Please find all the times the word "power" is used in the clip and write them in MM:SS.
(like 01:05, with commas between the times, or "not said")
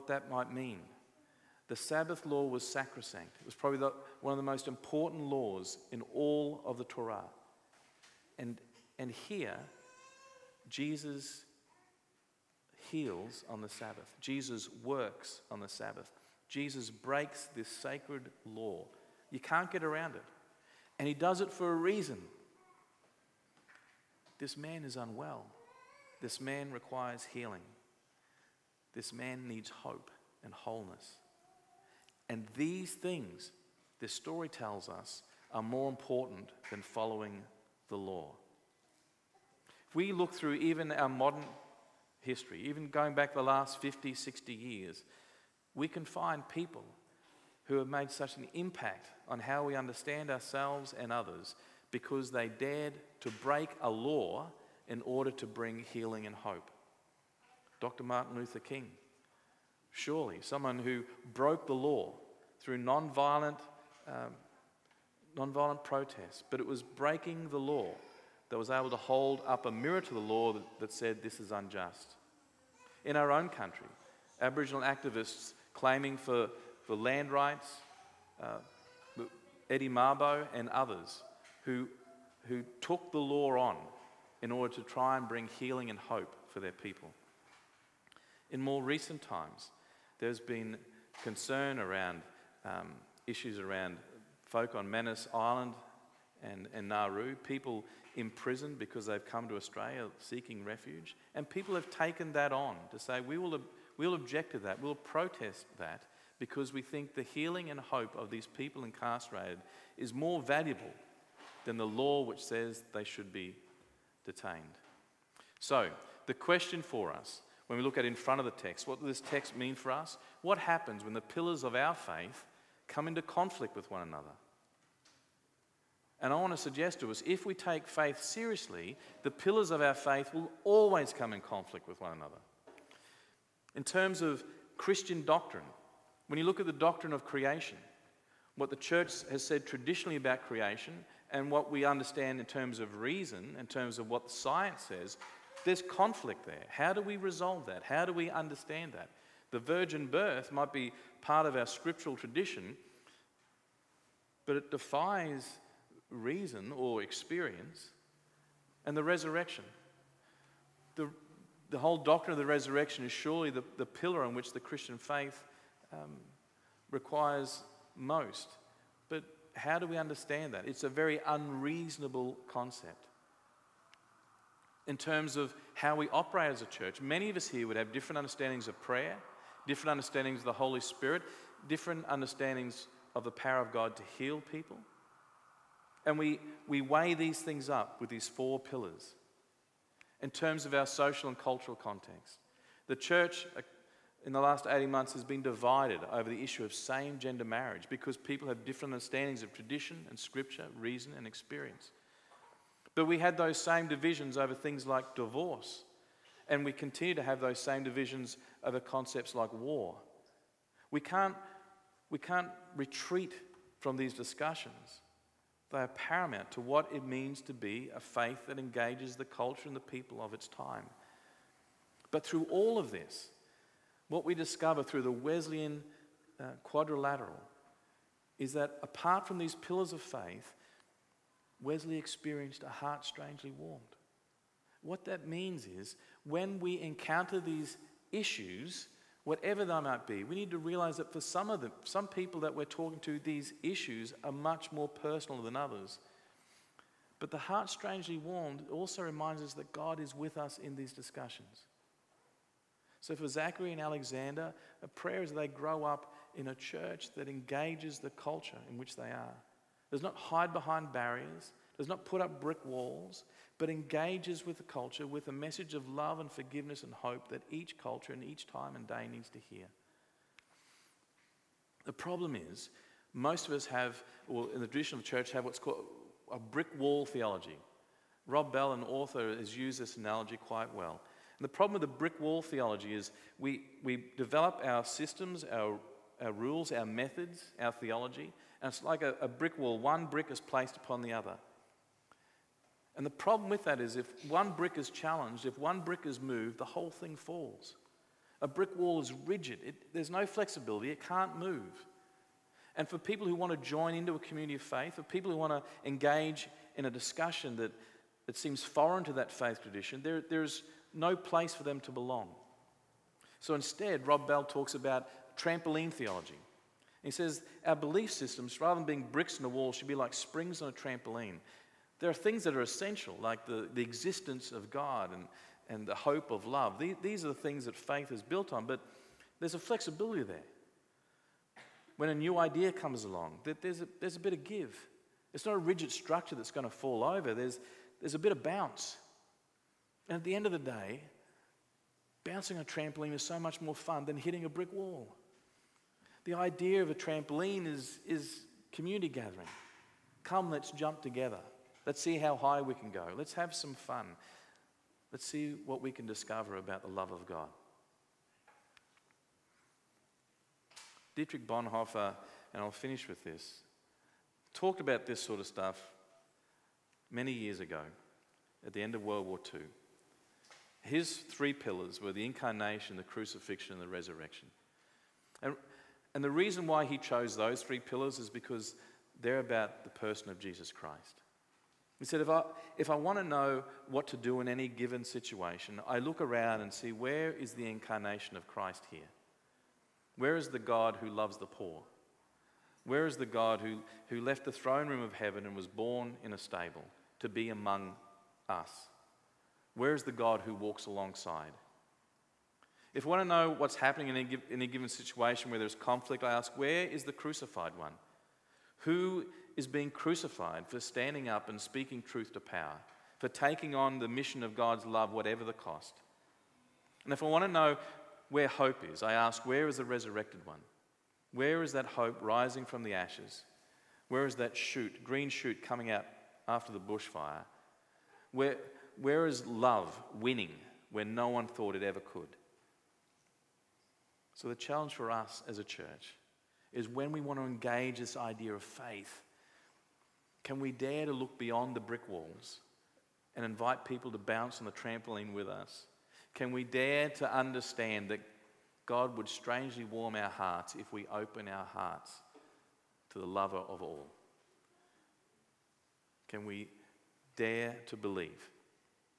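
03:03, 06:52.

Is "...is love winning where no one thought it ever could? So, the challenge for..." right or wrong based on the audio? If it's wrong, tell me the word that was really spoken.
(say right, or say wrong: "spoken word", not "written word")
right.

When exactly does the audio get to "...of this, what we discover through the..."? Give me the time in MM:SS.
03:42.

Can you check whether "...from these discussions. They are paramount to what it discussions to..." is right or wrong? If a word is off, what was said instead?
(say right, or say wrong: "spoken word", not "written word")
wrong: "means", not "discussions".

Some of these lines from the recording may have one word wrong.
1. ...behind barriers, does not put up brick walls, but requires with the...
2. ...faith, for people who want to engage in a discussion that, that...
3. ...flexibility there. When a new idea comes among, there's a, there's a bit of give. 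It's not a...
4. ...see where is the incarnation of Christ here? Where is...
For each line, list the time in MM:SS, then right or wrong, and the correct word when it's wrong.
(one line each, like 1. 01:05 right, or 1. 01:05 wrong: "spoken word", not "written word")
1. 04:20 wrong: "engages", not "requires"
2. 05:04 right
3. 05:29 wrong: "along", not "among"
4. 06:26 right.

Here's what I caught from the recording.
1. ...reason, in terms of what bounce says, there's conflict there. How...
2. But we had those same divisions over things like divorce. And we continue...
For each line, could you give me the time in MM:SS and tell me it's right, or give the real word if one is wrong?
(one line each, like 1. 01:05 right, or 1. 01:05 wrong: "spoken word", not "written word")
1. 02:22 wrong: "science", not "bounce"
2. 03:22 right.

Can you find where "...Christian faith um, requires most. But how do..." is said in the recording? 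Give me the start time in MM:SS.
02:44.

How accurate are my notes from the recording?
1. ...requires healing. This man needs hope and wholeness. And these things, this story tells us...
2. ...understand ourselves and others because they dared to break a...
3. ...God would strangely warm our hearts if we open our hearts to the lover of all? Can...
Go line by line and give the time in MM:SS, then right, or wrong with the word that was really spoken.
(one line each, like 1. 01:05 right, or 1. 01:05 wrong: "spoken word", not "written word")
1. 00:26 right
2. 00:49 right
3. 07:28 right.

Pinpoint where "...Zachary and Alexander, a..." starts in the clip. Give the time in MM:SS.
04:13.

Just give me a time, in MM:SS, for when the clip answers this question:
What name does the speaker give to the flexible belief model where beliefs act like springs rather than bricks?
05:15.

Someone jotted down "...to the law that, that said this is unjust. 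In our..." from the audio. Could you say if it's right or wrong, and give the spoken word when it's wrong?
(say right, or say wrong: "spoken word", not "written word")
right.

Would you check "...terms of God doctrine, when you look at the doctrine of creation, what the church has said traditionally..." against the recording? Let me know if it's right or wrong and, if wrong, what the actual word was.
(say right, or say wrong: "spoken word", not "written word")
wrong: "Christian", not "God".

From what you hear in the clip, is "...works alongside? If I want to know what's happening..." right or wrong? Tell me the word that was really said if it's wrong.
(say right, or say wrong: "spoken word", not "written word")
wrong: "walks", not "works".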